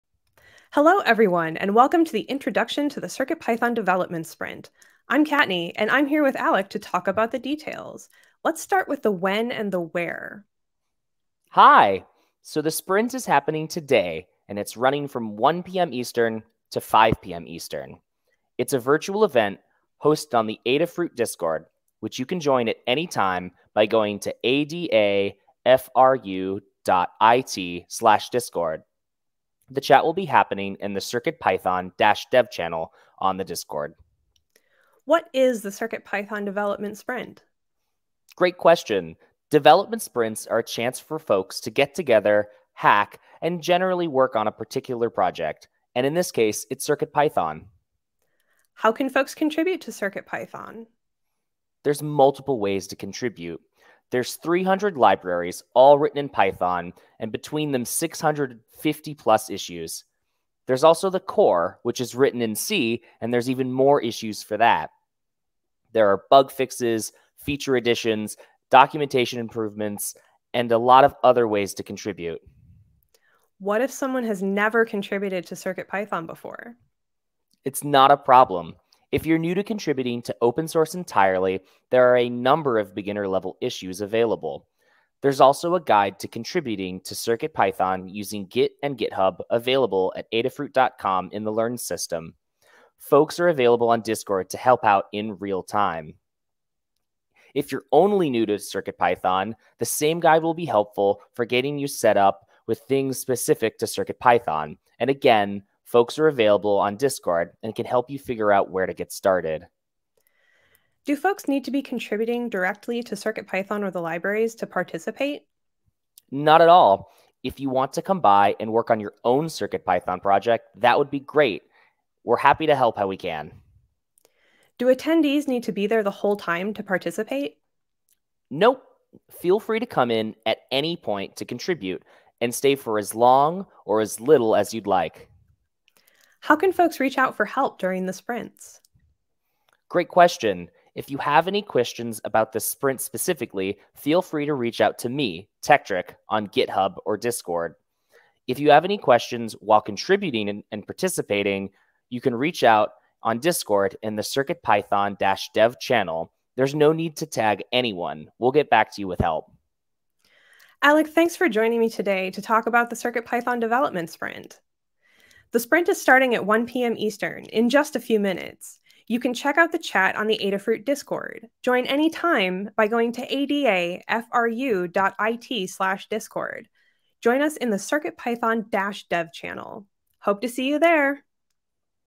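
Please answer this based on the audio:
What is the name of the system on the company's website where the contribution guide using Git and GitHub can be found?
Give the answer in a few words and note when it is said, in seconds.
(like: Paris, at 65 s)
Learn, at 91 s.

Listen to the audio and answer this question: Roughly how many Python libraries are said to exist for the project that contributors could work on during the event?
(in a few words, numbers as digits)
300.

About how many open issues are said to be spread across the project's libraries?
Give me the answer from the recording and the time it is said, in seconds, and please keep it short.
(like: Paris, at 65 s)
650+, at 57 s.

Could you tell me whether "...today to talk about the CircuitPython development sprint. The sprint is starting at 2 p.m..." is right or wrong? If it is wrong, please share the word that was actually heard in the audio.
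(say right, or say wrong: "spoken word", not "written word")
wrong: "1", not "2".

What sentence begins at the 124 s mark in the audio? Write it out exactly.
Do attendees need to be there the whole time to participate?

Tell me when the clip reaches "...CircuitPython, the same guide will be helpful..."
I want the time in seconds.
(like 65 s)
98 s.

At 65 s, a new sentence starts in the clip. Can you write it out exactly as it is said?
There are bug fixes, feature additions, documentation improvements, and a lot of other ways to contribute.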